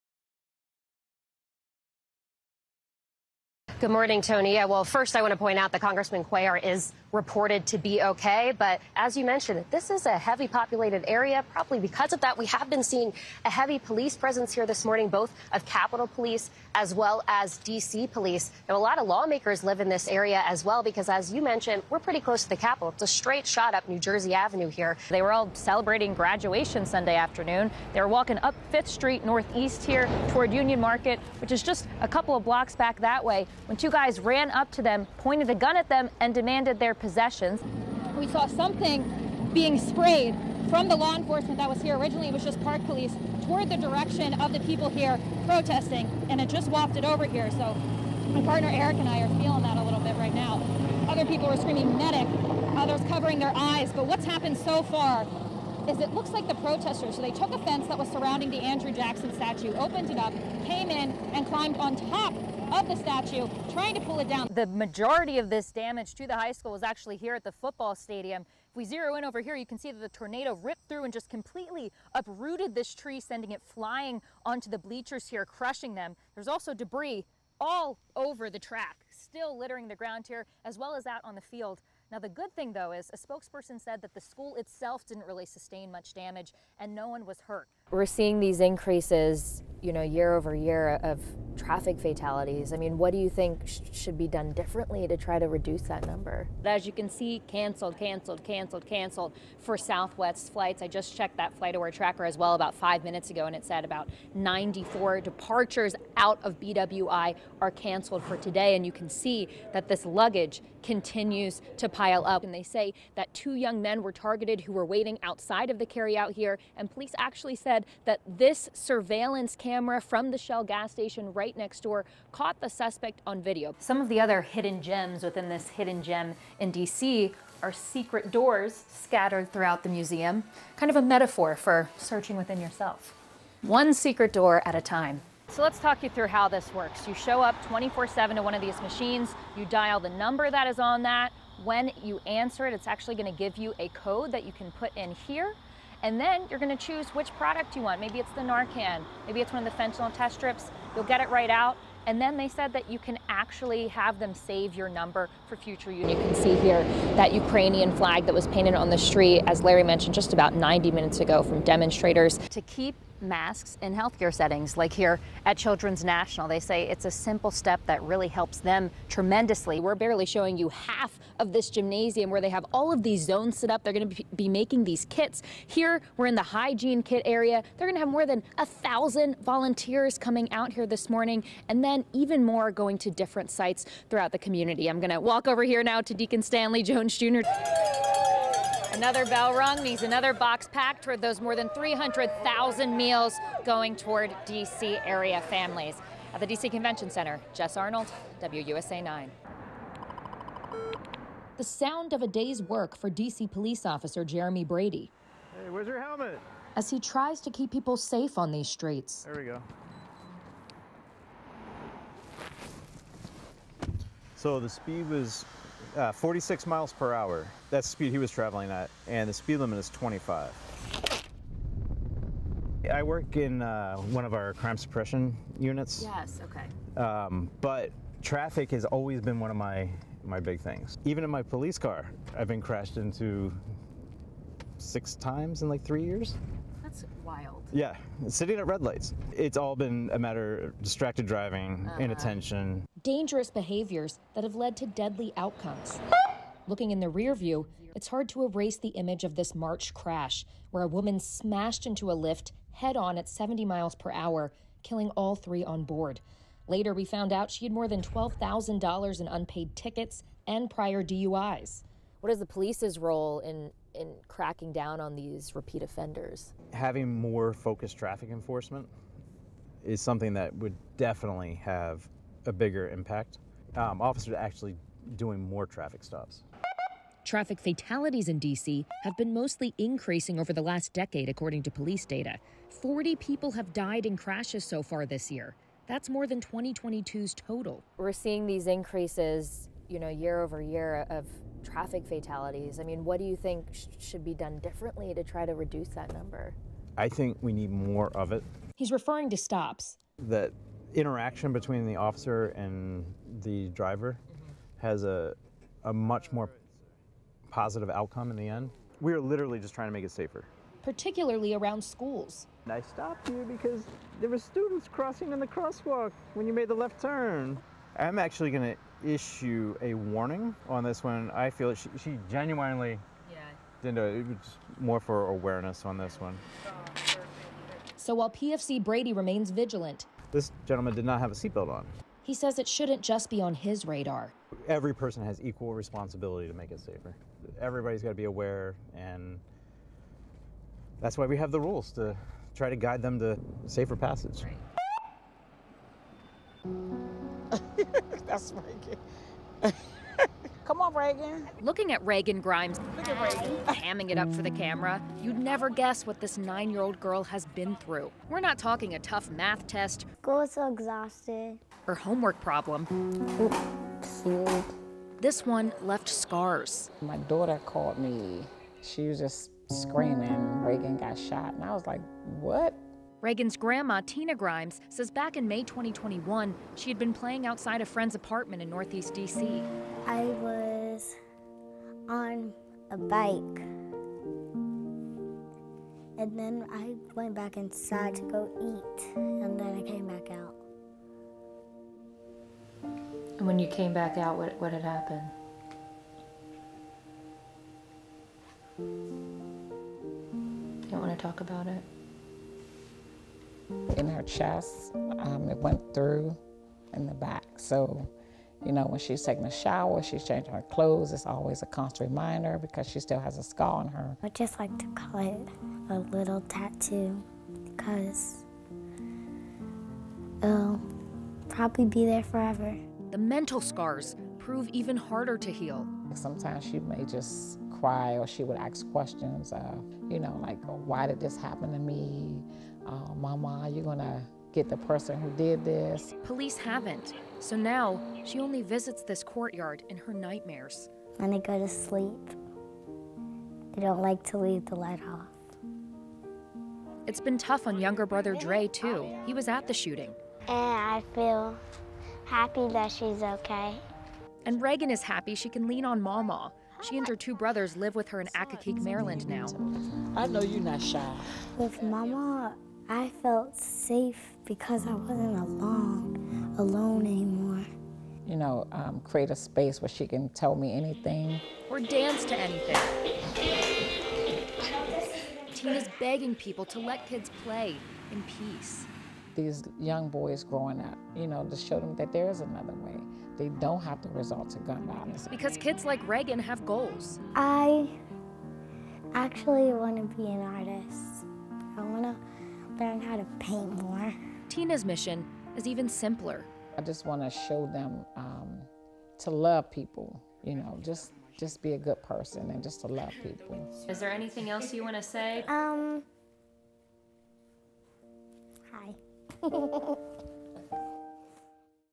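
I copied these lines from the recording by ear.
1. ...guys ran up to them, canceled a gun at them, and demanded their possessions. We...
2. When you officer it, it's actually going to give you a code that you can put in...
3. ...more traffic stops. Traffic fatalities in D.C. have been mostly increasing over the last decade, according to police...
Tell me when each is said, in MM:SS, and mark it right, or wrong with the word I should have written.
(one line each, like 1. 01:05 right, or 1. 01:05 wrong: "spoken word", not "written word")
1. 00:33 wrong: "pointed", not "canceled"
2. 02:21 wrong: "answer", not "officer"
3. 04:35 right.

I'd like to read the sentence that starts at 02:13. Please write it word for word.
One secret door at a time.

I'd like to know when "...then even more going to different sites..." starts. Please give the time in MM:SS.
03:01.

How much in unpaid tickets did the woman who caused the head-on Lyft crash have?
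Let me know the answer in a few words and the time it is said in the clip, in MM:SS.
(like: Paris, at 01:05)
$12,000, at 04:18.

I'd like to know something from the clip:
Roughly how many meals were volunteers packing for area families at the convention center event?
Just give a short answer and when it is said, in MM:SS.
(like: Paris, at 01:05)
300,000, at 03:11.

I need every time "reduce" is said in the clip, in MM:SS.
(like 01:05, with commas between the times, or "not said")
01:35, 04:55.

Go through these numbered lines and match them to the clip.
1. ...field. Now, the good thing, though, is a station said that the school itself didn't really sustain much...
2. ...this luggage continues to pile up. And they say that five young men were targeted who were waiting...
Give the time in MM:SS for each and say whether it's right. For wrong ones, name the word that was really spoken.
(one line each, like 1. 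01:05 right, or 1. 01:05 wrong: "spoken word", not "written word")
1. 01:21 wrong: "spokesperson", not "station"
2. 01:49 wrong: "two", not "five".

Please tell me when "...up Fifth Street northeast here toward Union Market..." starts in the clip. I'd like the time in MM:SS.
00:28.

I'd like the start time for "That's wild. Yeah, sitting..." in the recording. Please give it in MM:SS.
03:56.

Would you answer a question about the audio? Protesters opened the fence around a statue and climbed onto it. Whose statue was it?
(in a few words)
Andrew Jackson.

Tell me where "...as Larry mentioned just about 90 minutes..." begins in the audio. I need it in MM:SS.
02:39.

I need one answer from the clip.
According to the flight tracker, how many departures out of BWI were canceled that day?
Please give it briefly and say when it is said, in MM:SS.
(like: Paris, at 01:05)
94, at 01:44.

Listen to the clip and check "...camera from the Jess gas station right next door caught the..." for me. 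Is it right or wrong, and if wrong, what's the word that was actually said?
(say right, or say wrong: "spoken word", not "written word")
wrong: "Shell", not "Jess".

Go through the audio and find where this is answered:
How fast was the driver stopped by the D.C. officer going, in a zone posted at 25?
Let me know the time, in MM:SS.
03:36.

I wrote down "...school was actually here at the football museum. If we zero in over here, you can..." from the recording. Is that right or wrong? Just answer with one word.
wrong.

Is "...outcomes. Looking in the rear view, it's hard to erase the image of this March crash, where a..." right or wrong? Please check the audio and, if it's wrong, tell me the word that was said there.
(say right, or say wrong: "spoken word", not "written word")
right.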